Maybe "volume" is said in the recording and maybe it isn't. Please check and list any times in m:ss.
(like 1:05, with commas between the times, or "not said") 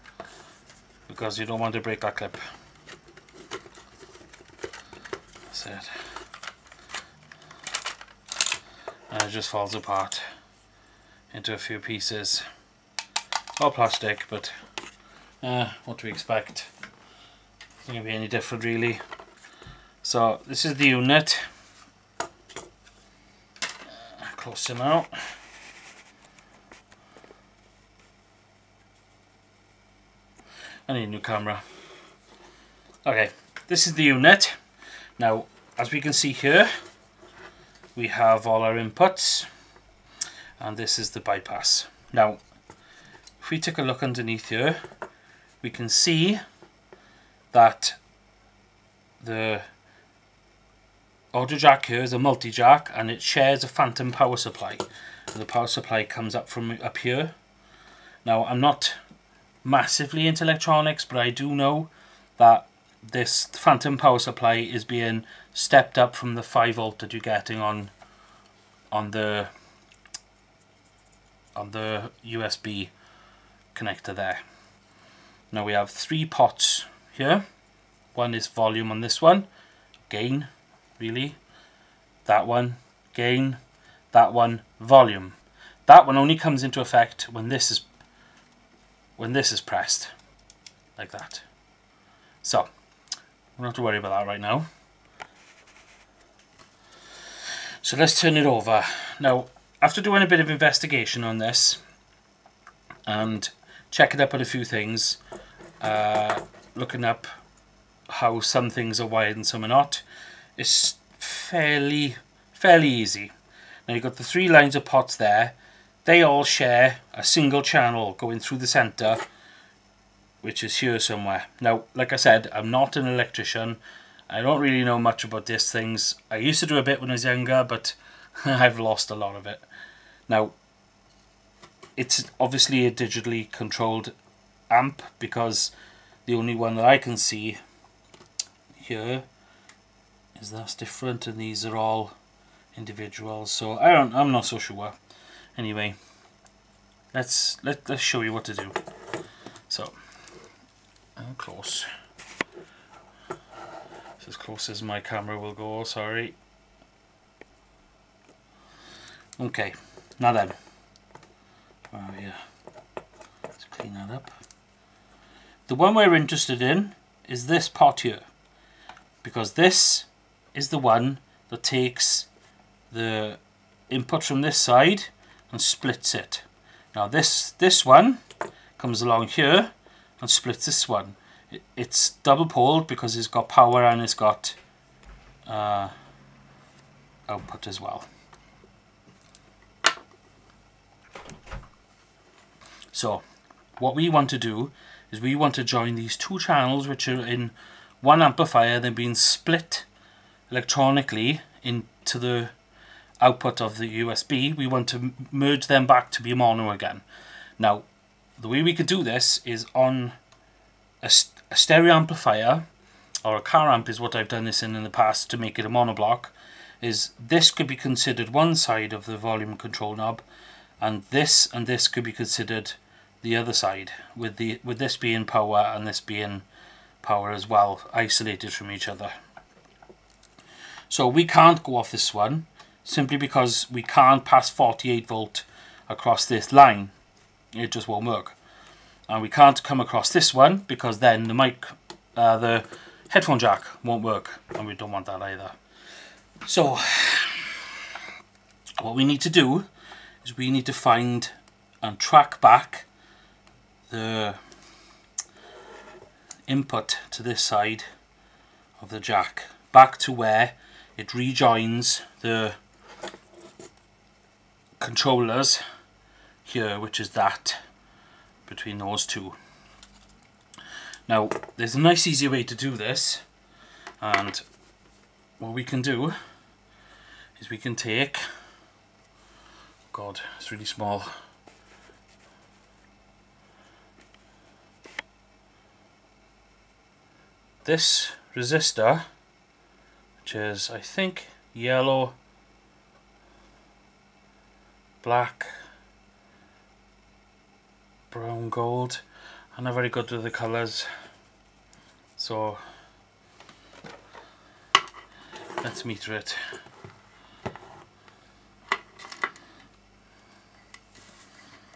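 1:18, 1:24, 3:39.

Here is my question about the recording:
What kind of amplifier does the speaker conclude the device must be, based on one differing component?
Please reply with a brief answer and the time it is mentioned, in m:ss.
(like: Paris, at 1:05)
digitally controlled amp, at 2:12.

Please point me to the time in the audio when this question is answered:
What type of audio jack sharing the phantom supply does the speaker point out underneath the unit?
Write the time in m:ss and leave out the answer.
0:52.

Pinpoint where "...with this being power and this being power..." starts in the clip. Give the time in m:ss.
3:44.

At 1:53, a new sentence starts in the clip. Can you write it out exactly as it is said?
Now you've got the three lines of pots there.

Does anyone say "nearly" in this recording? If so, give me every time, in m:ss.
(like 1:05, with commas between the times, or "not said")
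not said.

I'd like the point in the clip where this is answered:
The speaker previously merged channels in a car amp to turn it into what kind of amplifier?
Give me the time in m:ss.
3:35.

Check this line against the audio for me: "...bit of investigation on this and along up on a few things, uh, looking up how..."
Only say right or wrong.
wrong.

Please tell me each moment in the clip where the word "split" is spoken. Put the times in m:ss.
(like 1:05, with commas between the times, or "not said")
2:55, 3:00, 3:19.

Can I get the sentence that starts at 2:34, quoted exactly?
It's as close as my camera will go, sorry.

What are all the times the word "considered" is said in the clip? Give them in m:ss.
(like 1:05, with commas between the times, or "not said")
3:37, 3:42.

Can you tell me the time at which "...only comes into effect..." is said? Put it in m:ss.
1:26.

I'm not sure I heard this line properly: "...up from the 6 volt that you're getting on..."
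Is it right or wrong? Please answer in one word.
wrong.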